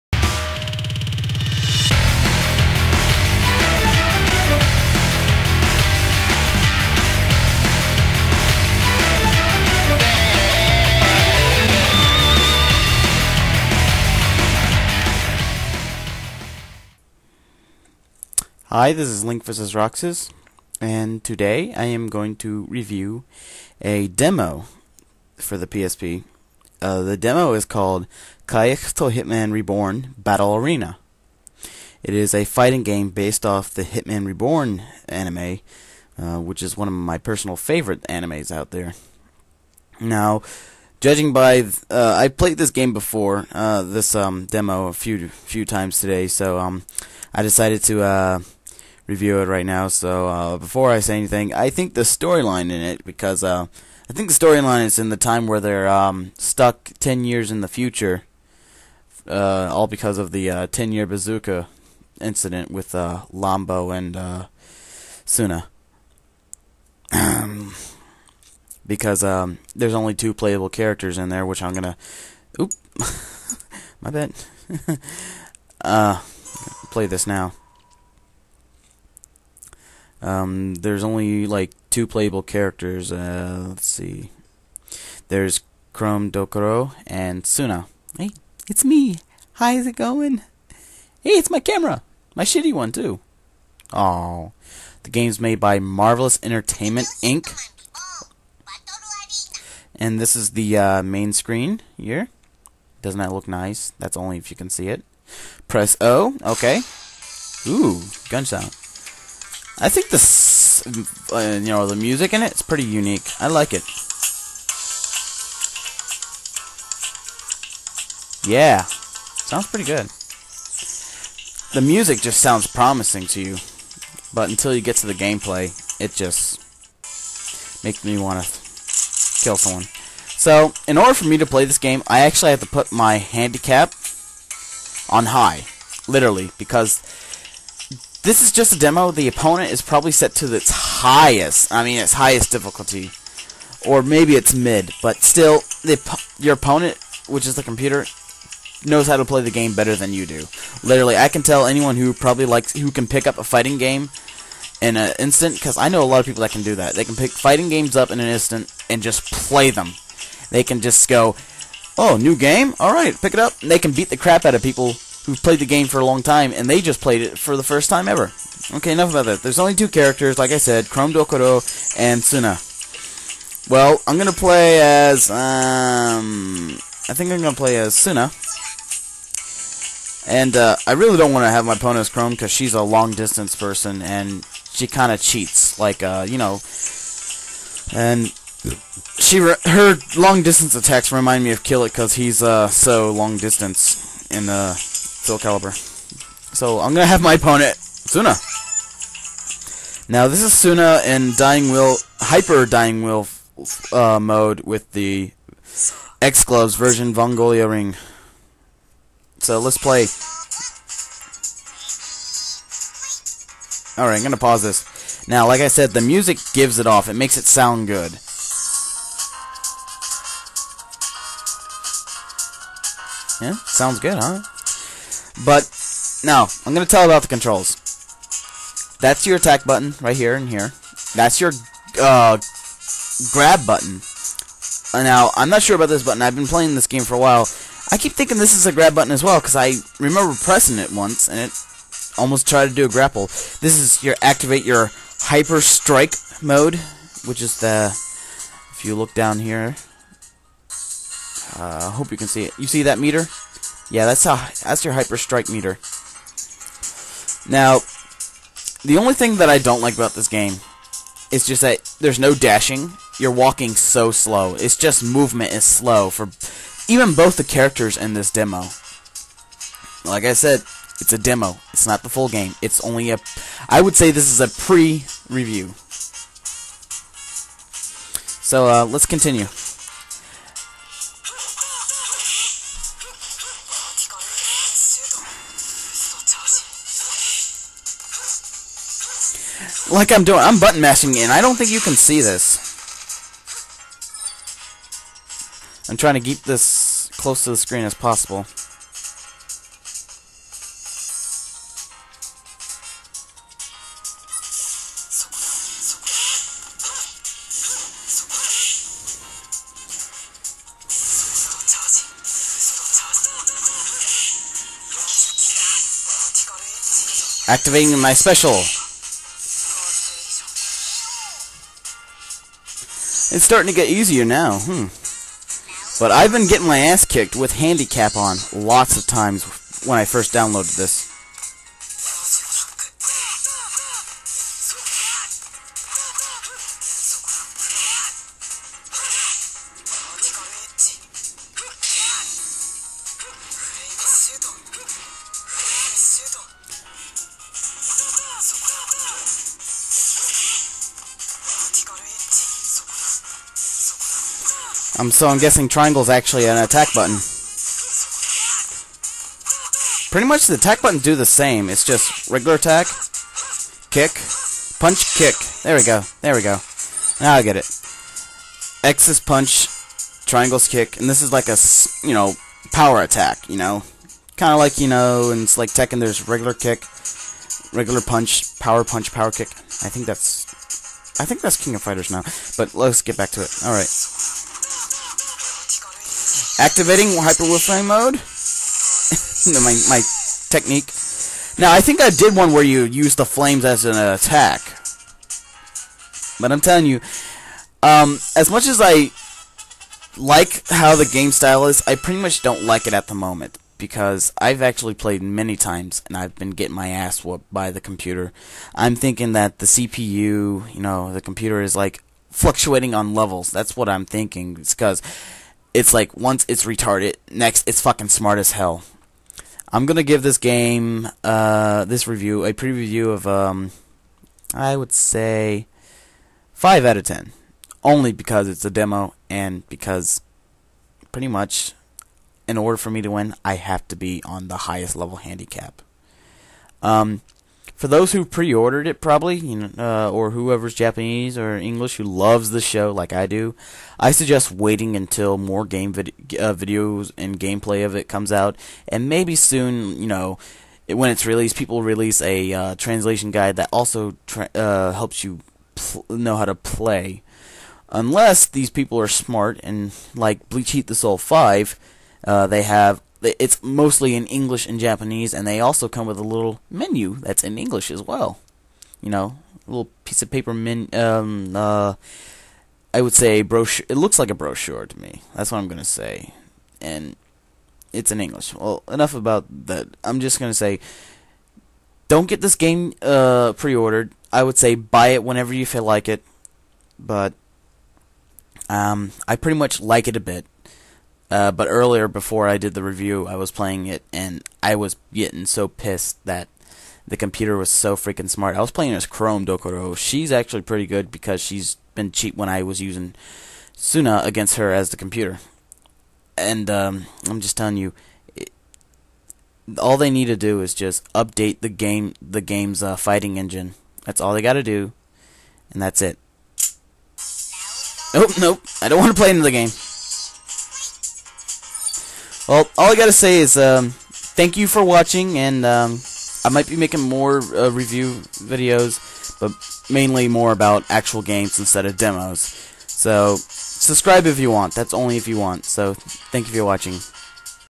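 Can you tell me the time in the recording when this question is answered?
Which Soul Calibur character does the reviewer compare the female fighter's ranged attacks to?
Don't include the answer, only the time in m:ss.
3:11.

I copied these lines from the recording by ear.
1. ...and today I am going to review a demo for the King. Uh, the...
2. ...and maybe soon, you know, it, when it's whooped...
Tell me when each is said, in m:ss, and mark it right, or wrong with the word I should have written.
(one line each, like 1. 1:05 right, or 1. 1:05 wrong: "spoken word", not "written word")
1. 0:20 wrong: "PSP", not "King"
2. 7:28 wrong: "released", not "whooped".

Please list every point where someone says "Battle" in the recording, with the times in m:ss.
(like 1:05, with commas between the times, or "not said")
0:30.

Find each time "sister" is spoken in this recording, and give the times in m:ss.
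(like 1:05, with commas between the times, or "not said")
not said.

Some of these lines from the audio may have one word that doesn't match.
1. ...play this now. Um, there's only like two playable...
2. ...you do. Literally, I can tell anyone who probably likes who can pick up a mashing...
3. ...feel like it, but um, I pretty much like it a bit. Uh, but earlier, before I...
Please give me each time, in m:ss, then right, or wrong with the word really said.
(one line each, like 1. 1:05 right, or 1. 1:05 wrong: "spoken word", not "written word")
1. 1:16 right
2. 2:30 wrong: "fighting", not "mashing"
3. 8:05 right.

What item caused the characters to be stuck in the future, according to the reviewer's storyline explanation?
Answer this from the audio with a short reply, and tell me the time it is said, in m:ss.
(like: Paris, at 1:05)
Ten-year bazooka, at 1:00.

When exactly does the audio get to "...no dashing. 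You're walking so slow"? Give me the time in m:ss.
4:22.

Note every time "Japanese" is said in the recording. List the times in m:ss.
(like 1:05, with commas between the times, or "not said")
7:20, 7:44.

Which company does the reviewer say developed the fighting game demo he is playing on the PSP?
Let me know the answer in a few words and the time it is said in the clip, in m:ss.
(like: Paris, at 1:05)
Marvelous Entertainment Inc., at 1:35.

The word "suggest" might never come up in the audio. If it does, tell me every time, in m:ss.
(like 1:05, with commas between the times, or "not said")
7:24.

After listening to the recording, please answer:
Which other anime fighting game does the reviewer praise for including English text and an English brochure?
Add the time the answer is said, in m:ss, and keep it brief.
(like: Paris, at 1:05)
Bleach Heat the Soul Five, at 7:40.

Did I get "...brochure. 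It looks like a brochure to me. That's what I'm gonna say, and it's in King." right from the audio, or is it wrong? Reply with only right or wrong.
wrong.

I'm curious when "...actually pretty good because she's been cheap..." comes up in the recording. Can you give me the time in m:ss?
8:20.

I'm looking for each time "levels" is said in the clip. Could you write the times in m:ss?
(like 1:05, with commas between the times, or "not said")
6:53, 7:14.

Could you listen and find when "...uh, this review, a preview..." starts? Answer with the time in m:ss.
7:01.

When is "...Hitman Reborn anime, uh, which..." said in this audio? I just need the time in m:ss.
0:33.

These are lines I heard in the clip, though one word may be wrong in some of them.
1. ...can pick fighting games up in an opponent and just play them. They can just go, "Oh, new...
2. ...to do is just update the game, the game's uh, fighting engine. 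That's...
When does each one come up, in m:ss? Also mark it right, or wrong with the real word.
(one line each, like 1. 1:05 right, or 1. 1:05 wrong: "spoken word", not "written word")
1. 2:37 wrong: "instant", not "opponent"
2. 8:30 right.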